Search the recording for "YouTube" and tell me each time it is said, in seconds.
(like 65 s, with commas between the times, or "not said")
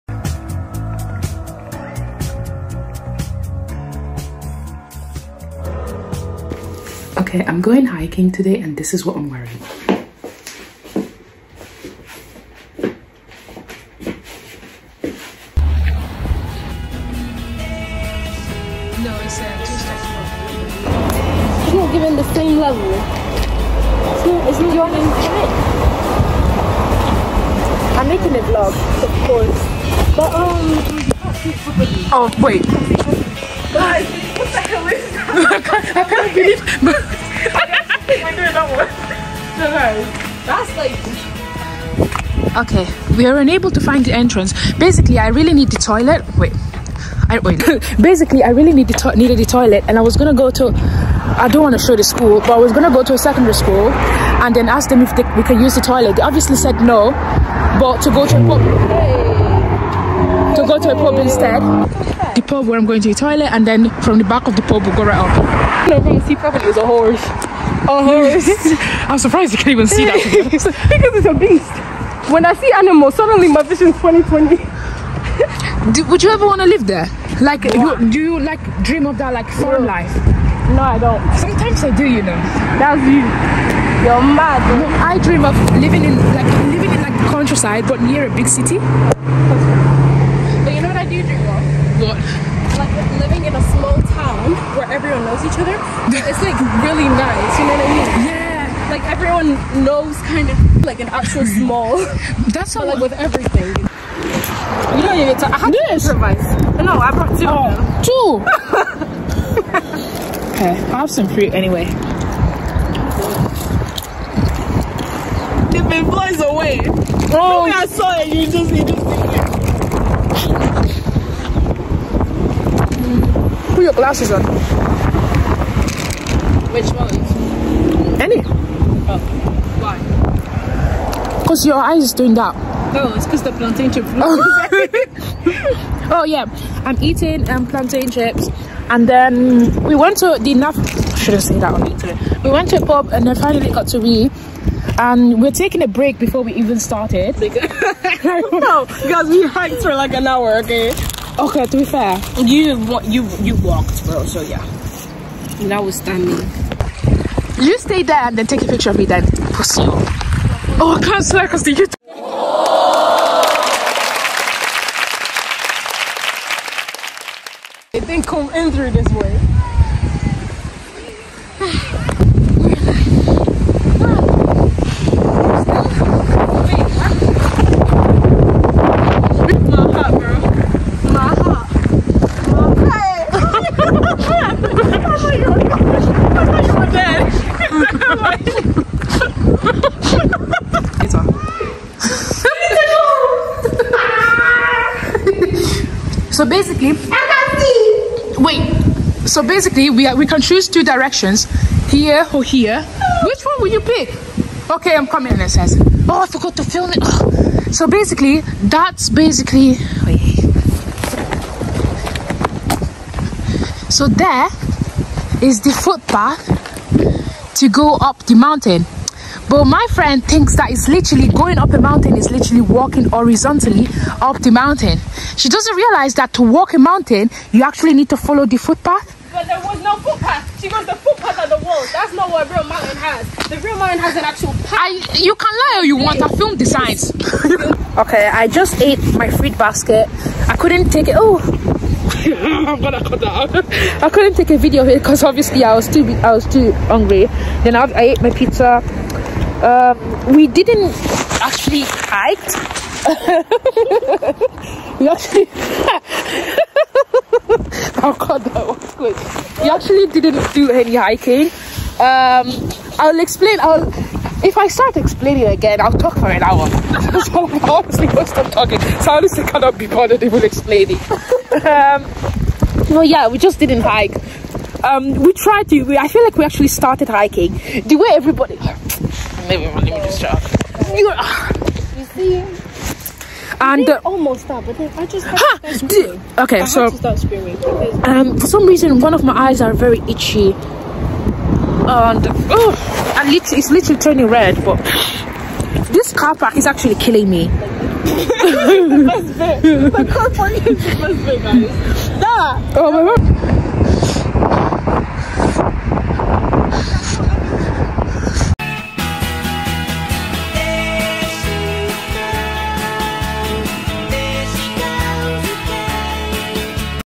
141 s, 161 s.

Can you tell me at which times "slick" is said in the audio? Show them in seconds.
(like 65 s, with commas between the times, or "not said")
not said.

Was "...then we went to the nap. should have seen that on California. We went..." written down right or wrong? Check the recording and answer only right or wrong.
wrong.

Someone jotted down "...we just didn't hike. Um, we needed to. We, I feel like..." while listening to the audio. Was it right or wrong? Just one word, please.
wrong.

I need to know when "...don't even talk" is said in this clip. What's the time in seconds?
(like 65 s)
105 s.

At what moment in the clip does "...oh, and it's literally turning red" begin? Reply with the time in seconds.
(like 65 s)
292 s.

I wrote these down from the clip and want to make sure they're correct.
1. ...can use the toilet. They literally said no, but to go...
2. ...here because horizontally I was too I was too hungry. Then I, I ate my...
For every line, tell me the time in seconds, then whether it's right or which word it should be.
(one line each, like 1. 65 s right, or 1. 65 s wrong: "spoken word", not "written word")
1. 55 s wrong: "obviously", not "literally"
2. 244 s wrong: "obviously", not "horizontally".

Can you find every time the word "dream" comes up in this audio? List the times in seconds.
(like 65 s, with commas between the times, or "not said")
78 s, 85 s.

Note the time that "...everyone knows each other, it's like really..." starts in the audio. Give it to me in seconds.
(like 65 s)
94 s.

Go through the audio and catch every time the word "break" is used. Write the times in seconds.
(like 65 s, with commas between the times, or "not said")
145 s.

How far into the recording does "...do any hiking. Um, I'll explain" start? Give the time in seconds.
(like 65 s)
260 s.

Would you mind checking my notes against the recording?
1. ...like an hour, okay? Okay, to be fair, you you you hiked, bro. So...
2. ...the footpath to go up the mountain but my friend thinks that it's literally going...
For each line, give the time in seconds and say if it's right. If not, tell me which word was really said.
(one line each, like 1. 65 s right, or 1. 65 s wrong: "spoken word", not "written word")
1. 149 s wrong: "walked", not "hiked"
2. 215 s right.